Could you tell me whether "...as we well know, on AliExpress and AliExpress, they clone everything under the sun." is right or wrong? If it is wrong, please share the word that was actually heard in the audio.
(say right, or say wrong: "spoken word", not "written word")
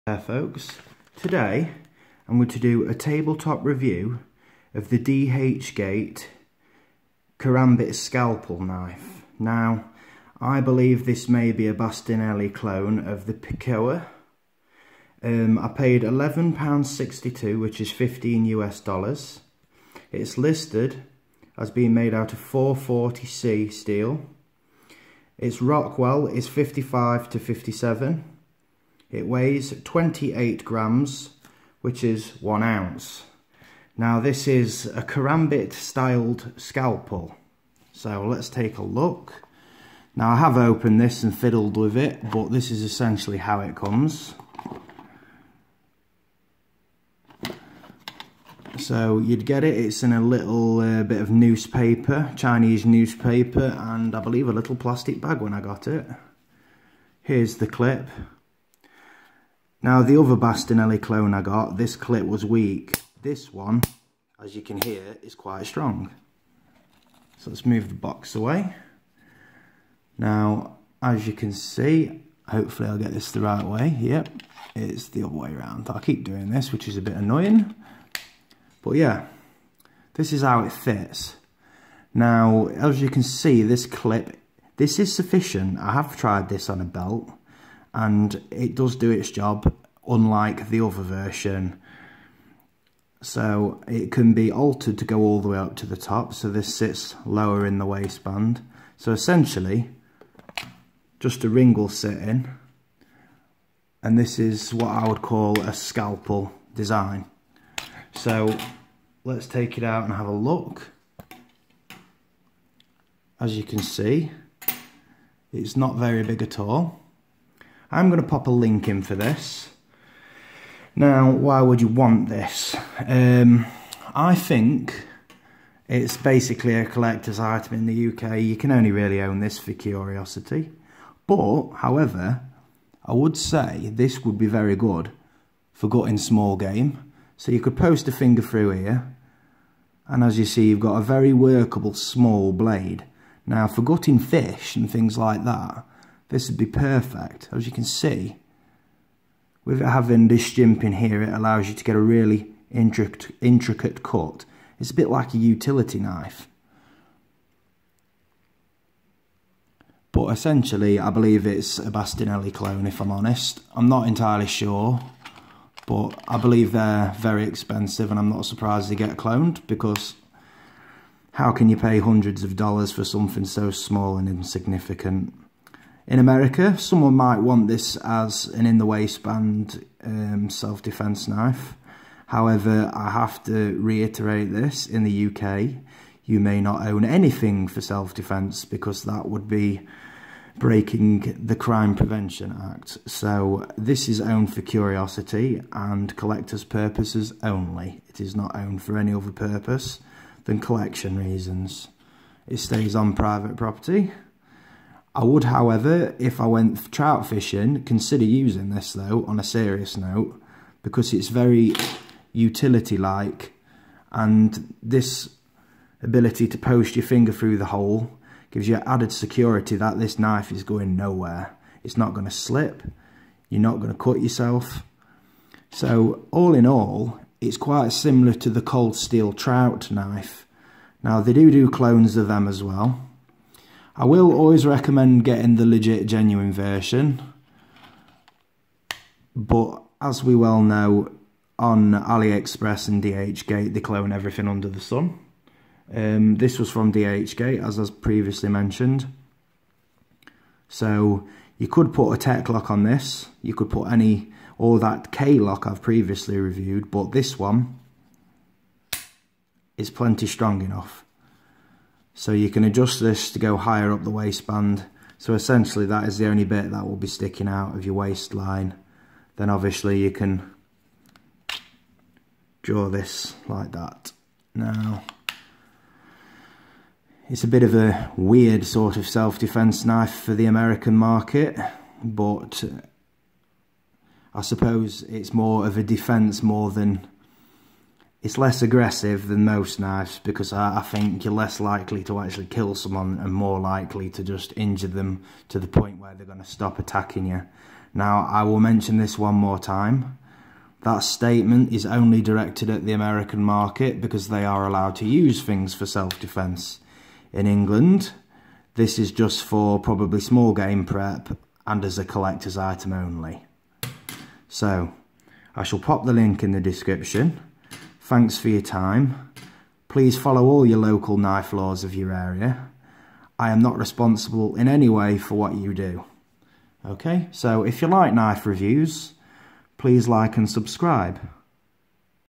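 wrong: "DHgate", not "AliExpress".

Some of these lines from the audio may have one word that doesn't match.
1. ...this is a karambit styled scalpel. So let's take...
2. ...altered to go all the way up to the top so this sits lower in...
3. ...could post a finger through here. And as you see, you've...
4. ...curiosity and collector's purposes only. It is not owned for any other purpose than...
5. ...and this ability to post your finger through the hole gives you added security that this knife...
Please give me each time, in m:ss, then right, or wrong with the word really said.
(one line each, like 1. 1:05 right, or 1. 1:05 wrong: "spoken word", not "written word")
1. 0:34 right
2. 1:34 right
3. 2:17 right
4. 3:14 right
5. 3:34 right.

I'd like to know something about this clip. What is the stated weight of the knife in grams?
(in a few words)
28 grams.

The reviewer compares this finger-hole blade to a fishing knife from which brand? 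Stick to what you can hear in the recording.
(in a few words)
Cold Steel.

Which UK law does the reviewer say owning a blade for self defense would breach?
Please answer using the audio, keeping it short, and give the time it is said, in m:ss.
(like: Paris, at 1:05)
Crime Prevention Act, at 3:11.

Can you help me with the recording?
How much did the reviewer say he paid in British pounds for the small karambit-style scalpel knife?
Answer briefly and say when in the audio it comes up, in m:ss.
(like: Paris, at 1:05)
£11.62, at 0:16.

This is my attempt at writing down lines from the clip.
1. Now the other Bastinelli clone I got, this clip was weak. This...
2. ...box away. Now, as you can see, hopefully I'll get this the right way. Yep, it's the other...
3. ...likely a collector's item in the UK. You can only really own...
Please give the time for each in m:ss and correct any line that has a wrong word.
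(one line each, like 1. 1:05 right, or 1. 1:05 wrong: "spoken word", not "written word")
1. 0:59 right
2. 1:07 right
3. 2:06 wrong: "basically", not "likely".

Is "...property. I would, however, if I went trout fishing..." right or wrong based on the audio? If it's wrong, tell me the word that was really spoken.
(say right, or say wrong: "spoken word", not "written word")
right.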